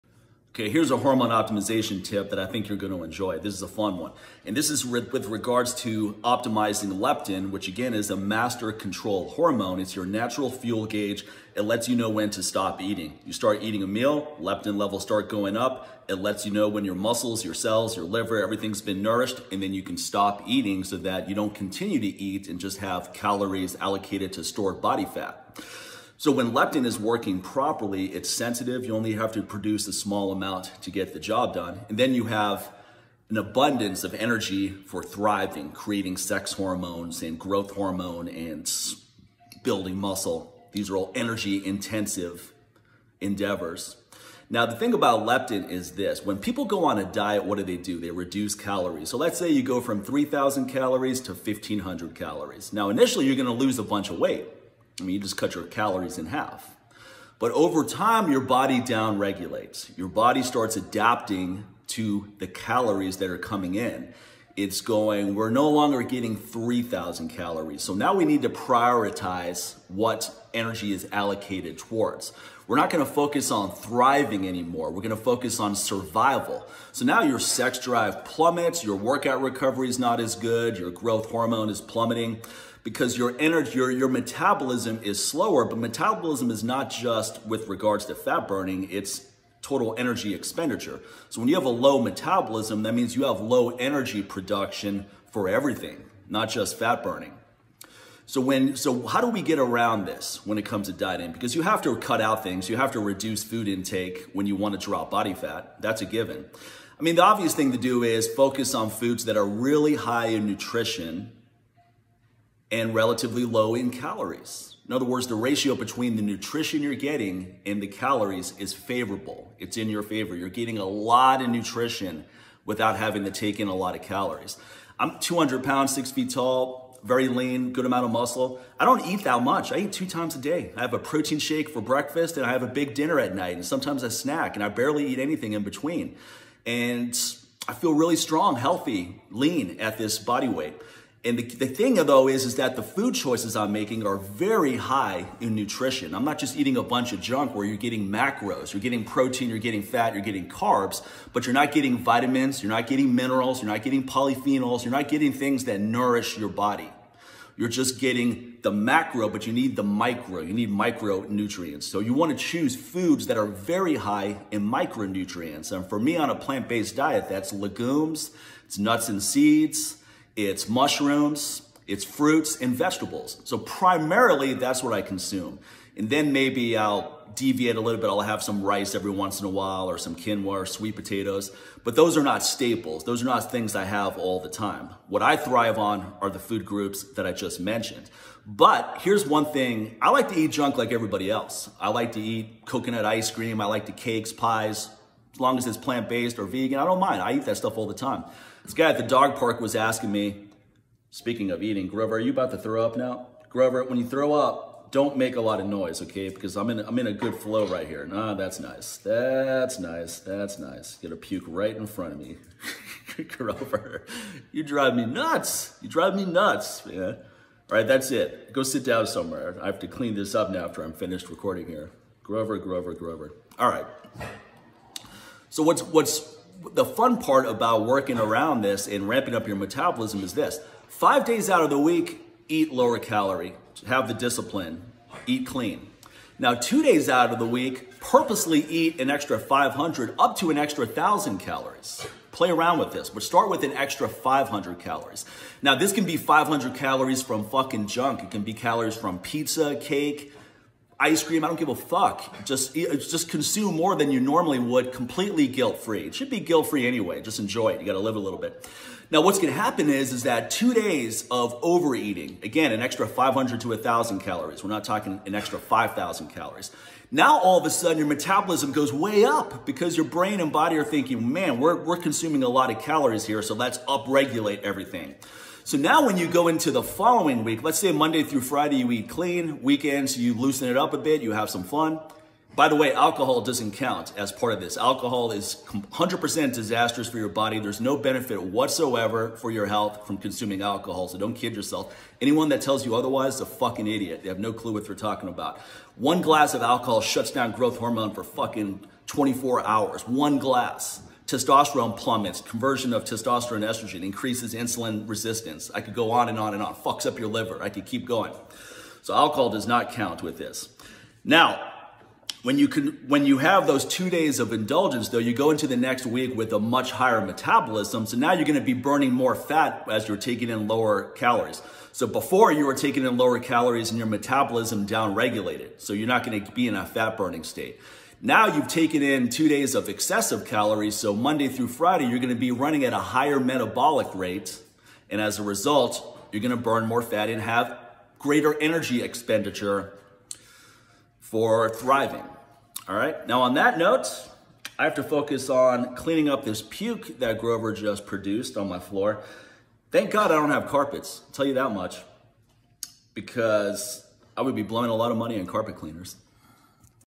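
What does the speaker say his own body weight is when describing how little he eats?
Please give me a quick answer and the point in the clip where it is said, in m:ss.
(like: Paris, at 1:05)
200 pounds, at 2:05.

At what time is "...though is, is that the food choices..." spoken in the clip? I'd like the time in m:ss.
2:21.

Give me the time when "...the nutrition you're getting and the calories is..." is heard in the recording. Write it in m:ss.
1:56.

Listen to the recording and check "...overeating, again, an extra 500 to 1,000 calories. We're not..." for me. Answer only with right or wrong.
right.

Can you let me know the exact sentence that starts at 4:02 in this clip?
Play around with this, but start with an extra 500 calories.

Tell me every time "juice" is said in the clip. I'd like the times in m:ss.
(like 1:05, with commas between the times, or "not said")
not said.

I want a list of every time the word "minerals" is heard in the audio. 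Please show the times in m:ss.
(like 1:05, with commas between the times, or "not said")
2:33.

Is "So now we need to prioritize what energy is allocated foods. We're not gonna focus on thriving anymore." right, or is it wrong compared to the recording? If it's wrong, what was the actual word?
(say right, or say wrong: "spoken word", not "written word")
wrong: "towards", not "foods".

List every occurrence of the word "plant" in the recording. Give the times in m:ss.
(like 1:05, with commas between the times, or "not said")
2:46, 3:15.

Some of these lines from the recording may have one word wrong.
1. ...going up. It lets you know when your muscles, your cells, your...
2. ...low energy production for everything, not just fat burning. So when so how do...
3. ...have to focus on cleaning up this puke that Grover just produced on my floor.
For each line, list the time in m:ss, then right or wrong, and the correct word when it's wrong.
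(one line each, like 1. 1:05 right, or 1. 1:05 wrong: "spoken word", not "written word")
1. 0:15 right
2. 1:33 right
3. 5:44 right.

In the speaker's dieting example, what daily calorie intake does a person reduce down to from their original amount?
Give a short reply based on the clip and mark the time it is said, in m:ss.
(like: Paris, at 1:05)
1,500 calories, at 0:51.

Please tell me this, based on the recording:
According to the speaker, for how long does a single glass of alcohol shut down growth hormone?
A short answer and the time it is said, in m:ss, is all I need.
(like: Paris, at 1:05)
24 hours, at 4:59.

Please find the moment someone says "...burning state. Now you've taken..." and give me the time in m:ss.
5:27.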